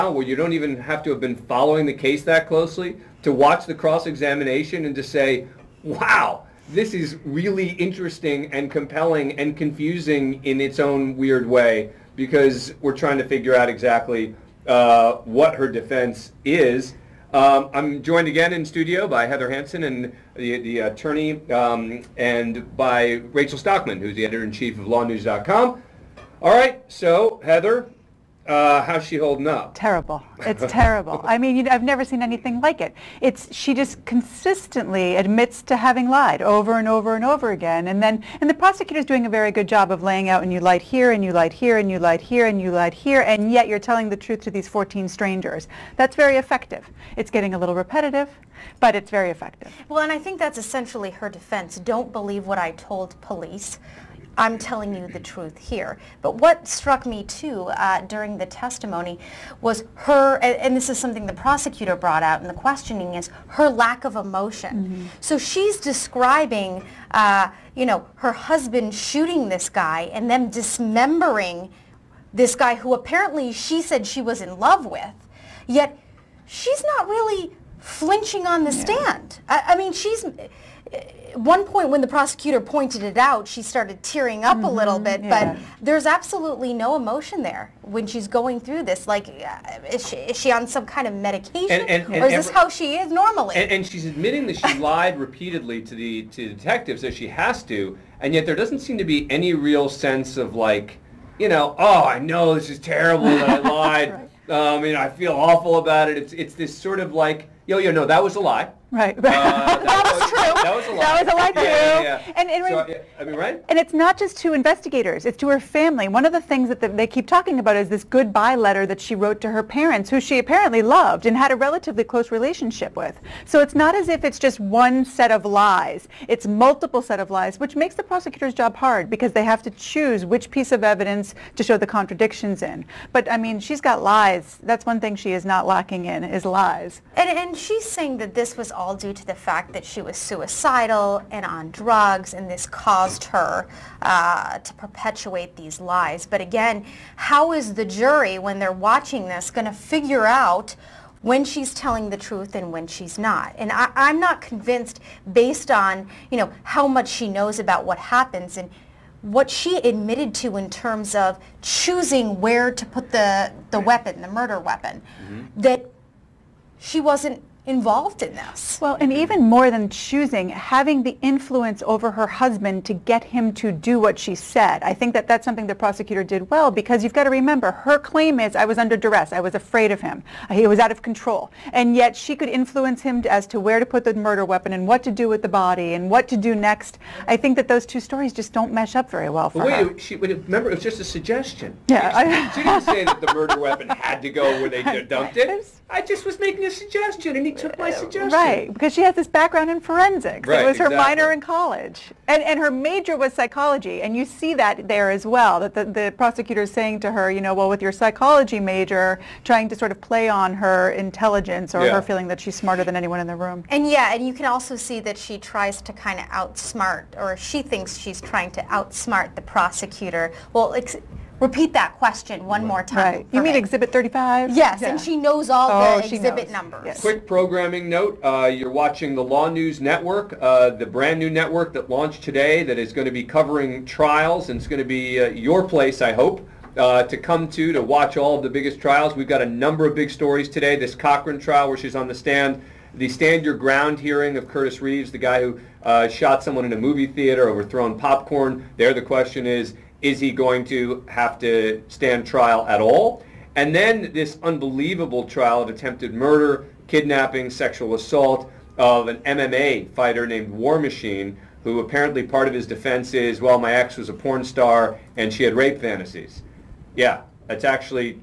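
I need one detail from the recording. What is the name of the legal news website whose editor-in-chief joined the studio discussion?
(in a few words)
LawNewz.com.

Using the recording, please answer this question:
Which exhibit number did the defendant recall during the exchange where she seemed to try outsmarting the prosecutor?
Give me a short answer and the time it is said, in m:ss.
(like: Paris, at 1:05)
35, at 3:43.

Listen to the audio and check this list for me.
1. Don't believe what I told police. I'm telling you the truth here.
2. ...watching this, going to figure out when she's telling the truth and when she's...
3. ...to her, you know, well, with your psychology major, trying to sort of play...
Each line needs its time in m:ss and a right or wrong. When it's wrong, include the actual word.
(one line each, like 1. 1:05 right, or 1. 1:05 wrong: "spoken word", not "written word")
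1. 0:51 right
2. 2:28 right
3. 3:27 right.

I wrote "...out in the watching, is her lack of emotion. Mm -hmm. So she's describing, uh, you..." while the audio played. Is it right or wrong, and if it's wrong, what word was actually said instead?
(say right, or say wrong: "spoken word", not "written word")
wrong: "questioning", not "watching".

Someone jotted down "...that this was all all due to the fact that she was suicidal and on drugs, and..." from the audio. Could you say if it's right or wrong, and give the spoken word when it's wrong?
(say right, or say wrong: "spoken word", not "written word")
right.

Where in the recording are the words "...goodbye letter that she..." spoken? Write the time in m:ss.
1:58.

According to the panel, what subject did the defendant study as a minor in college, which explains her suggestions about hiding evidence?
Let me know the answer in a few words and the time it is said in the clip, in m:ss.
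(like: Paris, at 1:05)
Forensics, at 3:19.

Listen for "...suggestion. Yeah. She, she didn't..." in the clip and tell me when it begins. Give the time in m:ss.
3:11.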